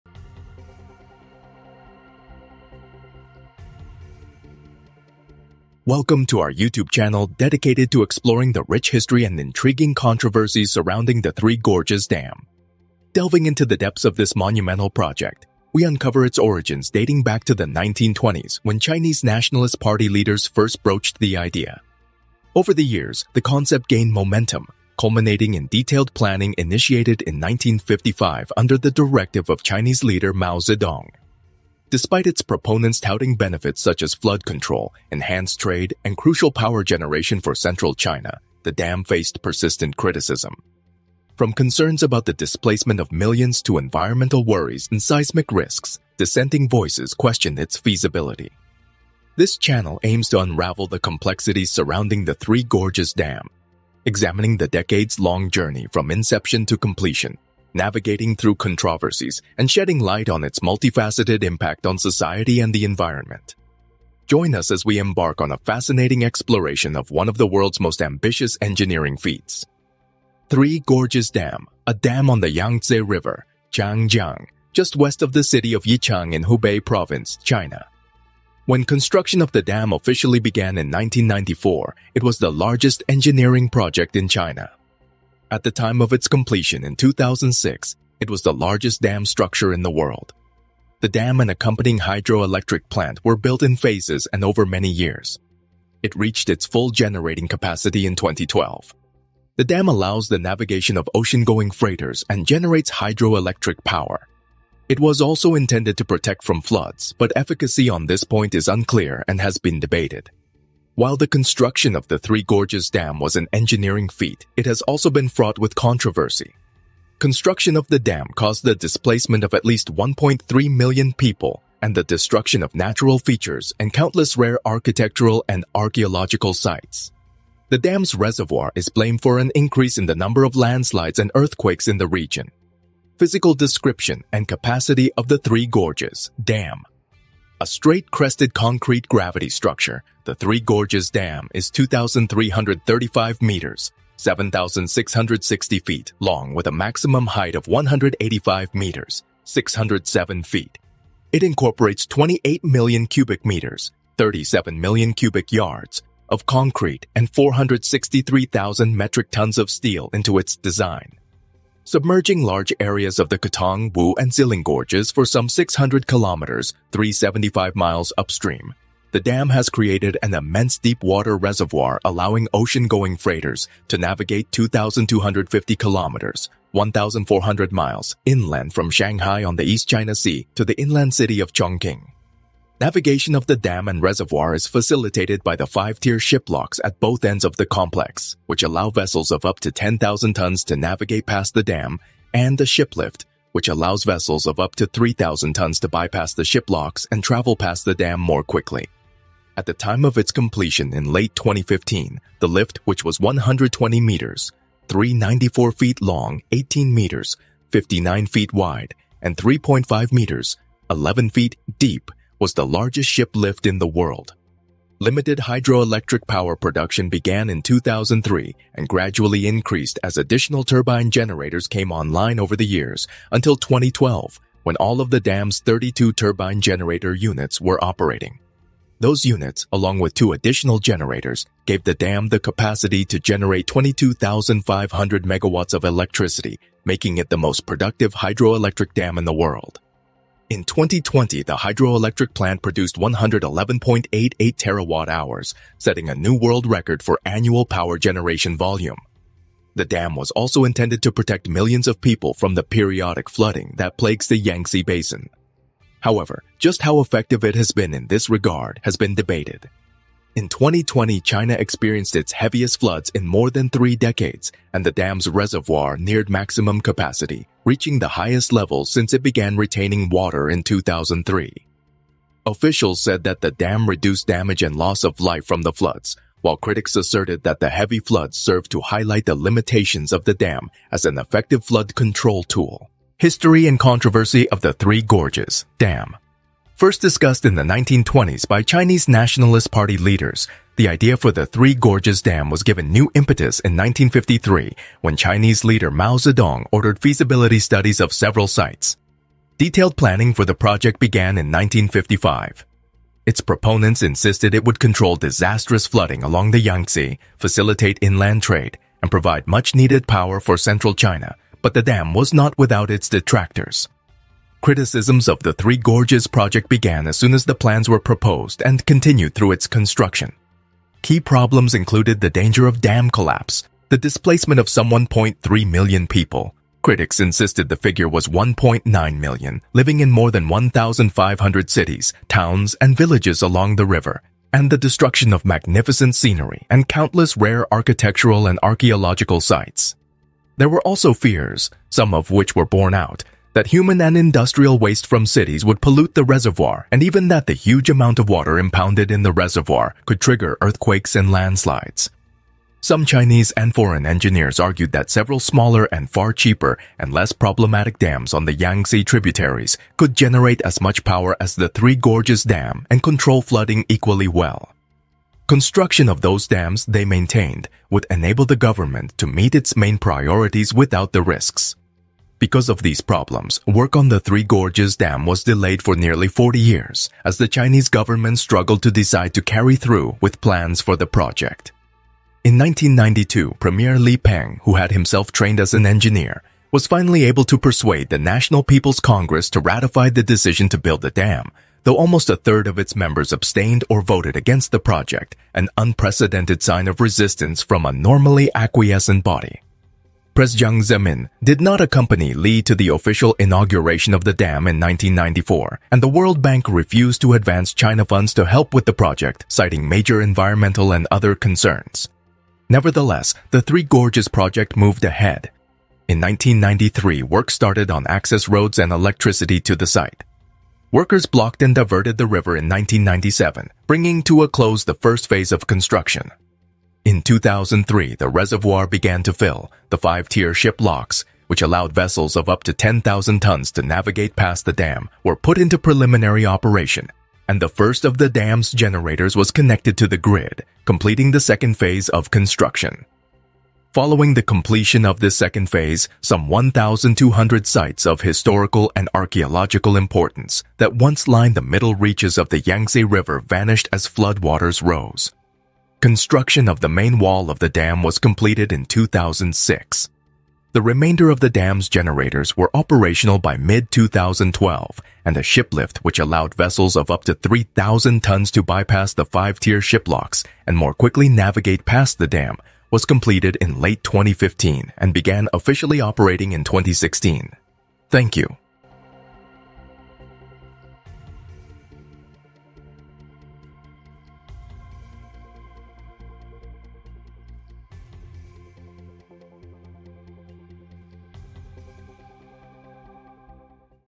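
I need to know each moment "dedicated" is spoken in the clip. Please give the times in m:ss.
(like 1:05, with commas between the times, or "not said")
0:07.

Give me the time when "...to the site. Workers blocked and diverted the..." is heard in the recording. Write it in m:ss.
6:59.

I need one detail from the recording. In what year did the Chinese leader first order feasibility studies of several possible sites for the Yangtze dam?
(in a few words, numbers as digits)
1953.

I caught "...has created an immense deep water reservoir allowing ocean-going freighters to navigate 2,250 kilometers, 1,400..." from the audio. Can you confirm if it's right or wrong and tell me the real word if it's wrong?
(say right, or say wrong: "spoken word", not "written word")
right.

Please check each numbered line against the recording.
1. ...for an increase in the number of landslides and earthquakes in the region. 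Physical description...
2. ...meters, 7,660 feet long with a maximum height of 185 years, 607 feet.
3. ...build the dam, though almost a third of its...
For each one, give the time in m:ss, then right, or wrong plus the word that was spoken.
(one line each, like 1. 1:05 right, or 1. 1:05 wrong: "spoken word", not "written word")
1. 2:09 right
2. 2:23 wrong: "meters", not "years"
3. 6:30 right.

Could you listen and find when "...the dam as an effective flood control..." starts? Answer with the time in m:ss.
4:40.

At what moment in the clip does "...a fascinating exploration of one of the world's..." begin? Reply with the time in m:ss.
1:05.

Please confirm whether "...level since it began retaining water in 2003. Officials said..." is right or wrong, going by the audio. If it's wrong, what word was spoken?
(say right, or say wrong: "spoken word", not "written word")
right.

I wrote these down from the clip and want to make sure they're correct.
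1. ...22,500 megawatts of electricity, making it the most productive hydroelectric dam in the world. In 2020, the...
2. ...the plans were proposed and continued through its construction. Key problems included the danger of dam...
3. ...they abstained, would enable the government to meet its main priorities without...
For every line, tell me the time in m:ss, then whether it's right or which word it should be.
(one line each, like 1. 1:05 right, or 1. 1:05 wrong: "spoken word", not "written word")
1. 3:53 right
2. 5:17 right
3. 6:06 wrong: "maintained", not "abstained".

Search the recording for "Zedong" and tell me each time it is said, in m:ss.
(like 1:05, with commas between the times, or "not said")
0:30, 4:56.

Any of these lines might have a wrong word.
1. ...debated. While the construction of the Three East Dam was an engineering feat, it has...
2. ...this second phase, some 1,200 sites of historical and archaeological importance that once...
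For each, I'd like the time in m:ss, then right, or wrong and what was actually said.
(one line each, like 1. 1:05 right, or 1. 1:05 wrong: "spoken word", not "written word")
1. 1:49 wrong: "Gorges", not "East"
2. 7:25 right.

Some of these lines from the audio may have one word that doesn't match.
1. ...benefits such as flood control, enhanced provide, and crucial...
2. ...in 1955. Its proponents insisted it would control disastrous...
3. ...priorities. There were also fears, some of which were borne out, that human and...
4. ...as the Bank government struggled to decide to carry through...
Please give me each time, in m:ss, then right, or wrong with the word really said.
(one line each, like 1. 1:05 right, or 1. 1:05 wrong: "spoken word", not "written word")
1. 0:33 wrong: "trade", not "provide"
2. 5:01 right
3. 5:39 wrong: "sites", not "priorities"
4. 6:17 wrong: "Chinese", not "Bank".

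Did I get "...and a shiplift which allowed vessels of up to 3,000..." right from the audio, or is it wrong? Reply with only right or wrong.
right.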